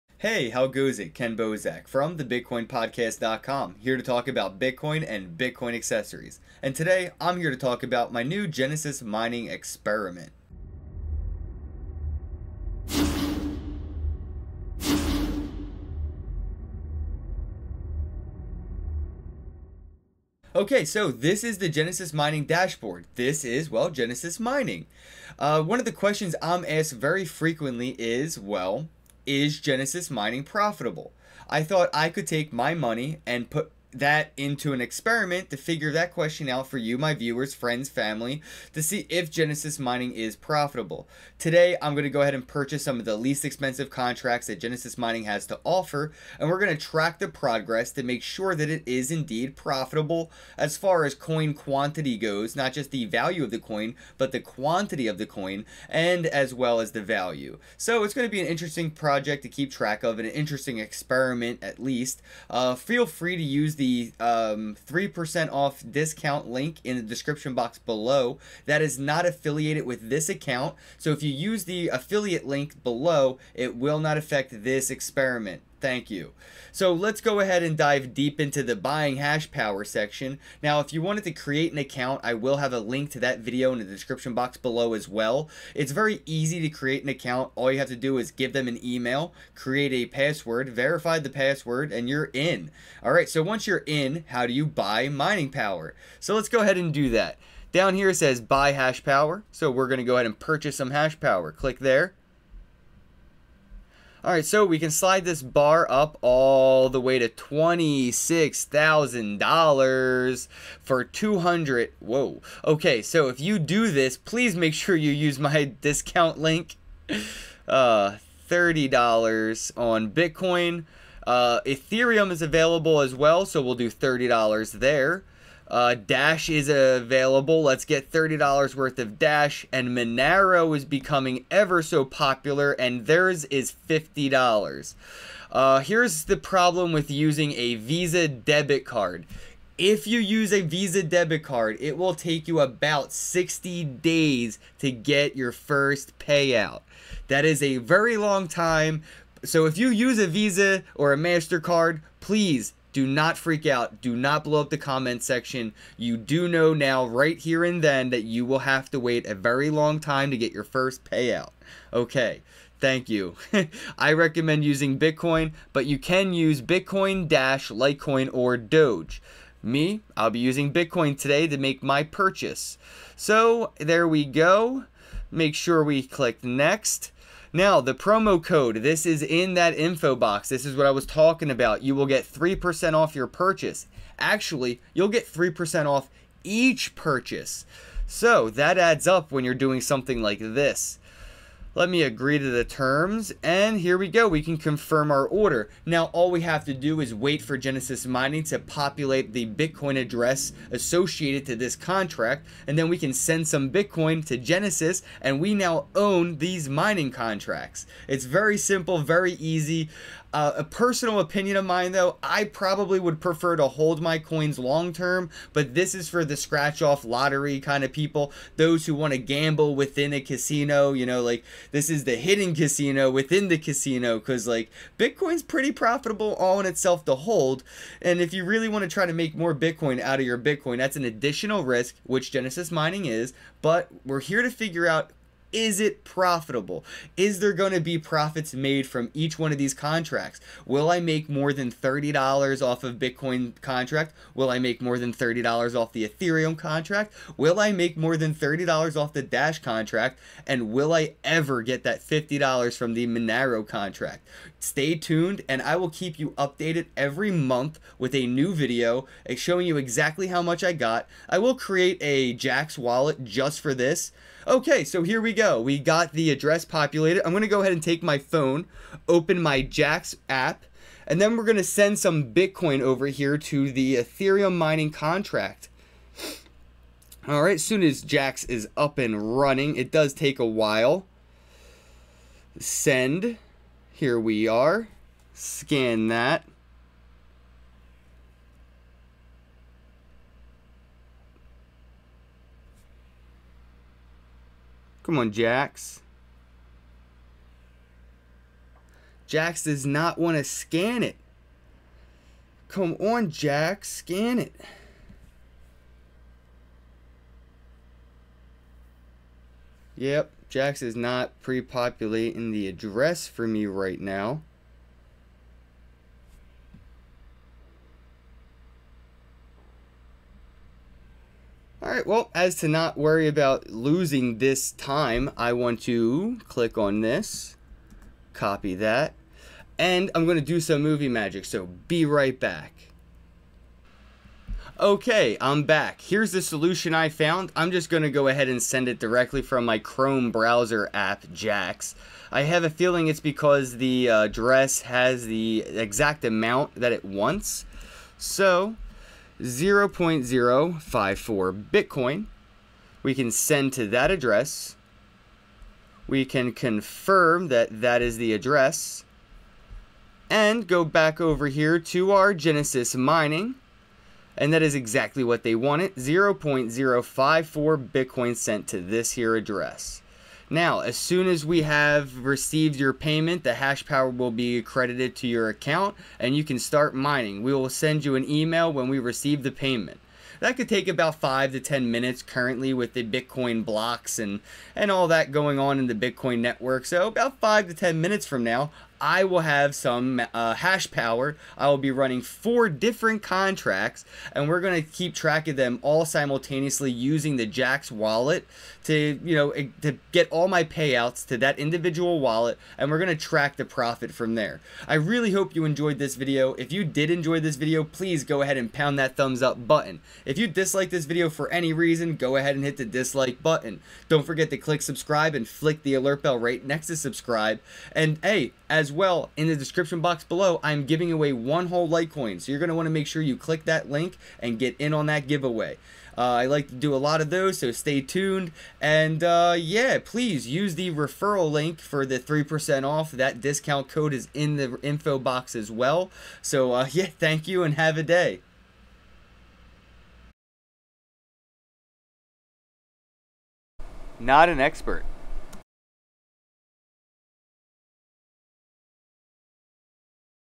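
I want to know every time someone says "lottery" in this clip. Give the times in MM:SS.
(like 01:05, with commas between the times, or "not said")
03:37.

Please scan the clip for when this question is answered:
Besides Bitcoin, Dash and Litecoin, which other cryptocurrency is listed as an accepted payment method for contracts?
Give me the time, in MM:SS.
02:48.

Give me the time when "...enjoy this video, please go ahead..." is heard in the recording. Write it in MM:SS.
06:47.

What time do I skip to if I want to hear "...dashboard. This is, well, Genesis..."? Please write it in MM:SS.
00:22.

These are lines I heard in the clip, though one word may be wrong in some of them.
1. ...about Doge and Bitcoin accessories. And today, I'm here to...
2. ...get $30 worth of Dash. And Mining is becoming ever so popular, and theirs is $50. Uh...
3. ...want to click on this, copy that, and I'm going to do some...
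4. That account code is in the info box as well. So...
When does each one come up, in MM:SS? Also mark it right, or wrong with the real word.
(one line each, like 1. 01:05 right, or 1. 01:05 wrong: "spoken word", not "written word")
1. 00:04 wrong: "Bitcoin", not "Doge"
2. 02:07 wrong: "Monero", not "Mining"
3. 05:25 right
4. 07:13 wrong: "discount", not "account".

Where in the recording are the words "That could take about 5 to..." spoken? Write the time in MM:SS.
06:20.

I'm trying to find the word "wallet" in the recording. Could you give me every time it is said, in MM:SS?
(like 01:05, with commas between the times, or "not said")
04:22, 06:37, 06:42.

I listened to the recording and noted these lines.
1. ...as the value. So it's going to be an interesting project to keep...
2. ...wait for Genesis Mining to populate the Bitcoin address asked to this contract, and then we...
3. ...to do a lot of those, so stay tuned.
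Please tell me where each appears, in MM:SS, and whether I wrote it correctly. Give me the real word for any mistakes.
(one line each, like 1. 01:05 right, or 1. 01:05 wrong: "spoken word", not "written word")
1. 00:56 right
2. 03:17 wrong: "associated", not "asked"
3. 07:06 right.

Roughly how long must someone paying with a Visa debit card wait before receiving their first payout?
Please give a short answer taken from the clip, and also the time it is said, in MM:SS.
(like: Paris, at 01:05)
60 days, at 02:23.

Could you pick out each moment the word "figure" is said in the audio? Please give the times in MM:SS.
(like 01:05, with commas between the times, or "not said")
00:35, 03:54.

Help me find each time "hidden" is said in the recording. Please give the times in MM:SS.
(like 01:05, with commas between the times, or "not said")
03:42.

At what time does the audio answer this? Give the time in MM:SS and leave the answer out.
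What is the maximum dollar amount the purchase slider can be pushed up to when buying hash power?
01:47.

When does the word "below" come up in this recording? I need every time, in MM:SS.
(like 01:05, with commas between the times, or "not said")
01:07, 01:12, 01:24, 07:00.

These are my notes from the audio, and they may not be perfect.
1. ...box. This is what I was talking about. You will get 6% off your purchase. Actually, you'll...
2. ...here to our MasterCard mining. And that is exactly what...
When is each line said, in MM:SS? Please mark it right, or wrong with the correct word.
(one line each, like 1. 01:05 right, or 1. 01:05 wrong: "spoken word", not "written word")
1. 03:00 wrong: "3", not "6"
2. 06:01 wrong: "Genesis", not "MasterCard".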